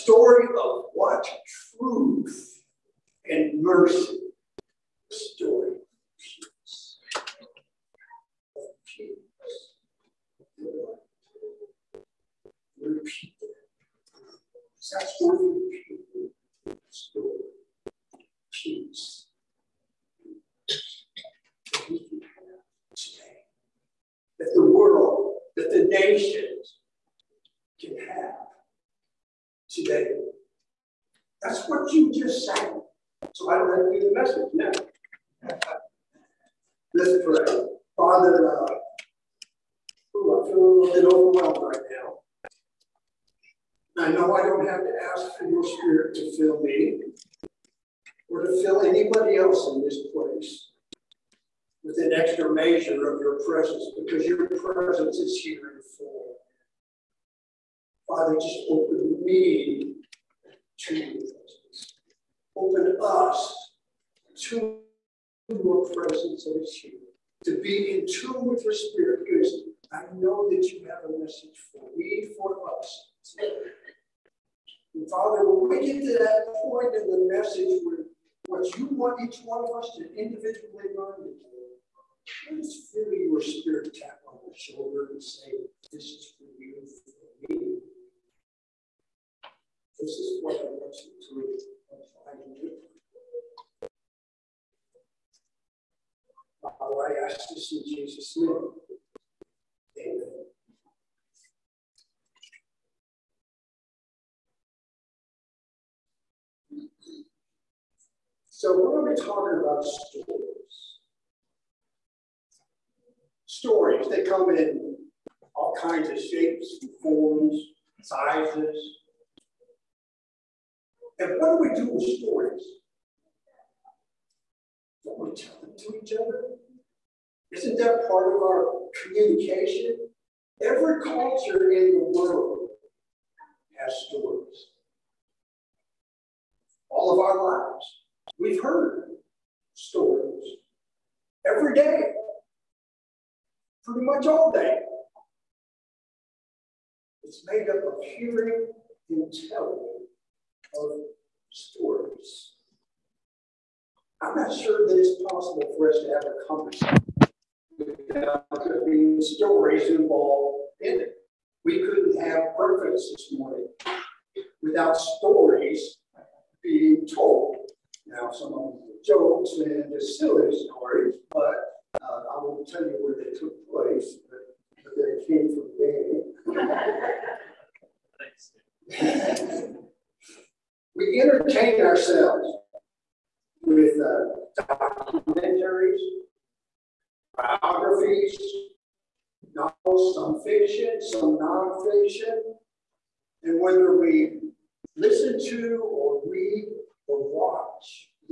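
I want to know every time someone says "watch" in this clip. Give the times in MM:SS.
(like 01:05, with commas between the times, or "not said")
03:17.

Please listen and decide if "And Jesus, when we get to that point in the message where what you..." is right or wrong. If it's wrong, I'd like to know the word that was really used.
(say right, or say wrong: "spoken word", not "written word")
wrong: "Father", not "Jesus".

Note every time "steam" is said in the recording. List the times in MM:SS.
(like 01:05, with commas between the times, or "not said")
not said.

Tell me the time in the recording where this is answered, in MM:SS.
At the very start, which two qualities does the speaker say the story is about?
00:01.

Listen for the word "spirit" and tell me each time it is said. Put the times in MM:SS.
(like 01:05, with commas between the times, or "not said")
00:45, 01:08, 01:23.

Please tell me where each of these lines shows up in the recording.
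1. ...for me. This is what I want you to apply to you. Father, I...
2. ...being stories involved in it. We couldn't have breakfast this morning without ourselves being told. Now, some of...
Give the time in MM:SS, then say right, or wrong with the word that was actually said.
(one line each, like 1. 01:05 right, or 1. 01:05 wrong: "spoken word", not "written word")
1. 01:27 right
2. 02:38 wrong: "stories", not "ourselves".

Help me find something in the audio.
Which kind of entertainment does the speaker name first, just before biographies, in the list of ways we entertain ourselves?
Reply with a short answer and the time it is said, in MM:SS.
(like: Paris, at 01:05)
Documentaries, at 03:04.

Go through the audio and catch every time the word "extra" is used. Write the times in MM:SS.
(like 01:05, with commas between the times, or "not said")
00:52.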